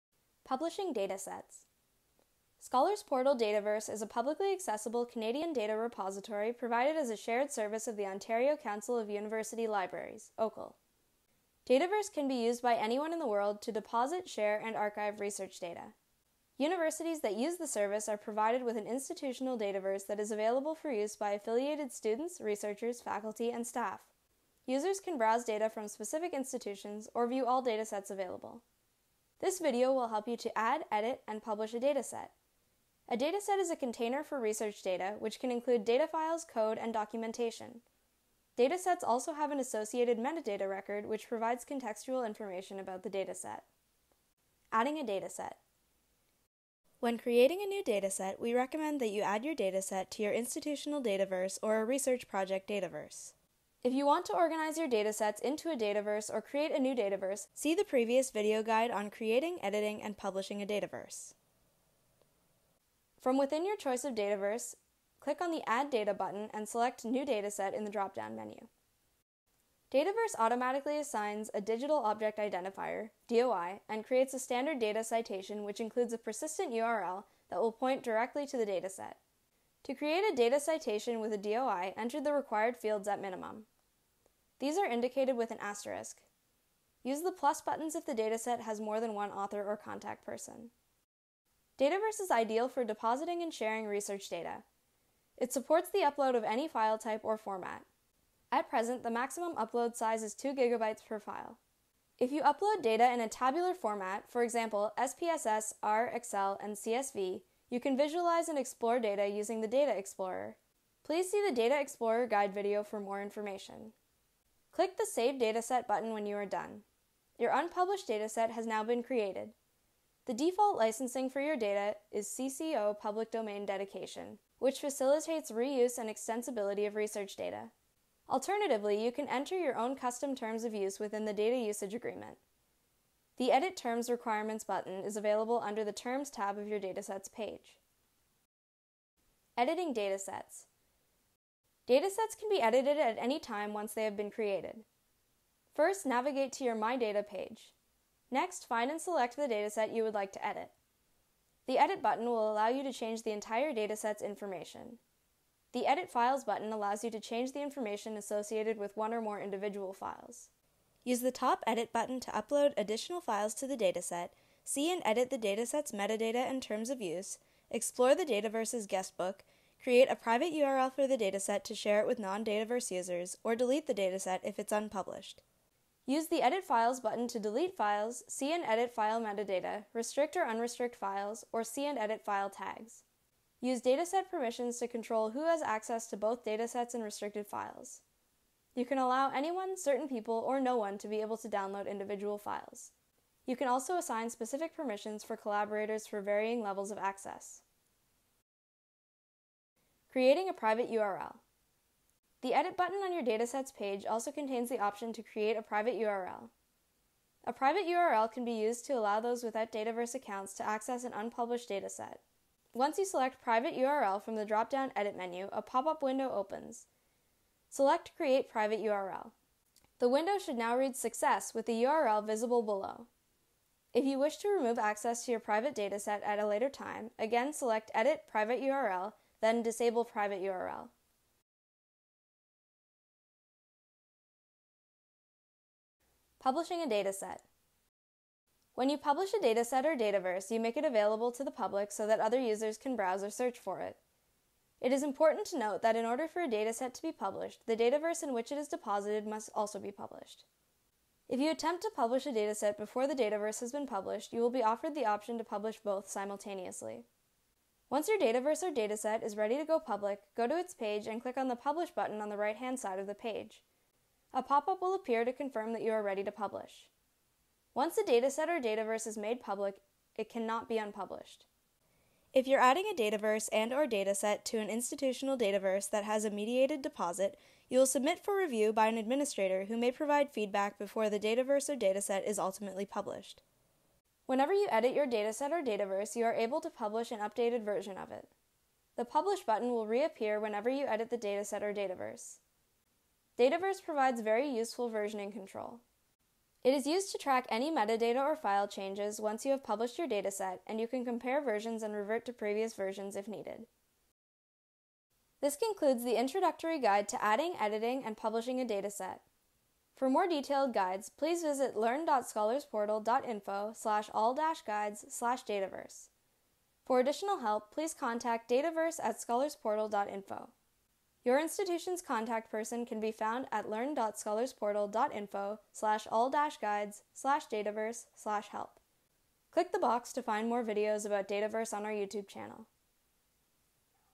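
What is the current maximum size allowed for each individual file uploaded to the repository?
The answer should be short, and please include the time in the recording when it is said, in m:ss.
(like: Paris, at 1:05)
2 gigabytes, at 1:40.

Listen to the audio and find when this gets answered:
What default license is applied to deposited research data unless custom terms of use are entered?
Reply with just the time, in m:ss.
2:02.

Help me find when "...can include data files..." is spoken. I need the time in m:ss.
0:35.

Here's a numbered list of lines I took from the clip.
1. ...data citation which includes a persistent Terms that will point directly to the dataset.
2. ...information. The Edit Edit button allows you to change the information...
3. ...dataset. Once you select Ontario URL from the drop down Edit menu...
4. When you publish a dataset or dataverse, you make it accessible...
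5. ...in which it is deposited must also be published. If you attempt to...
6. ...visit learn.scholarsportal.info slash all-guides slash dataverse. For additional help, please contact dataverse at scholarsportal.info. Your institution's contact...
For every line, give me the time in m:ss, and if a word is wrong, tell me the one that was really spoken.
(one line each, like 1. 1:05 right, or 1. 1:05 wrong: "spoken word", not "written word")
1. 1:14 wrong: "URL", not "Terms"
2. 2:34 wrong: "Files", not "Edit"
3. 3:31 wrong: "Private", not "Ontario"
4. 3:58 wrong: "available", not "accessible"
5. 4:08 right
6. 5:11 right.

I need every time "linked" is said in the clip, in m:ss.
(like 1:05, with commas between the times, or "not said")
not said.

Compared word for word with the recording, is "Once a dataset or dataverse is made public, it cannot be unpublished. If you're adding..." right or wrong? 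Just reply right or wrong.
right.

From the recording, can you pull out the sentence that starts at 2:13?
The Edit Terms Requirements button is available under the Terms tab of your Datasets page.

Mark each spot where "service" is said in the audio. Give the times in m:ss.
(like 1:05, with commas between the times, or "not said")
0:07, 0:17.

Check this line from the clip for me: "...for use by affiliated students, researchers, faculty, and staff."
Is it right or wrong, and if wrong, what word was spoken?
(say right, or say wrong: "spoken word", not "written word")
right.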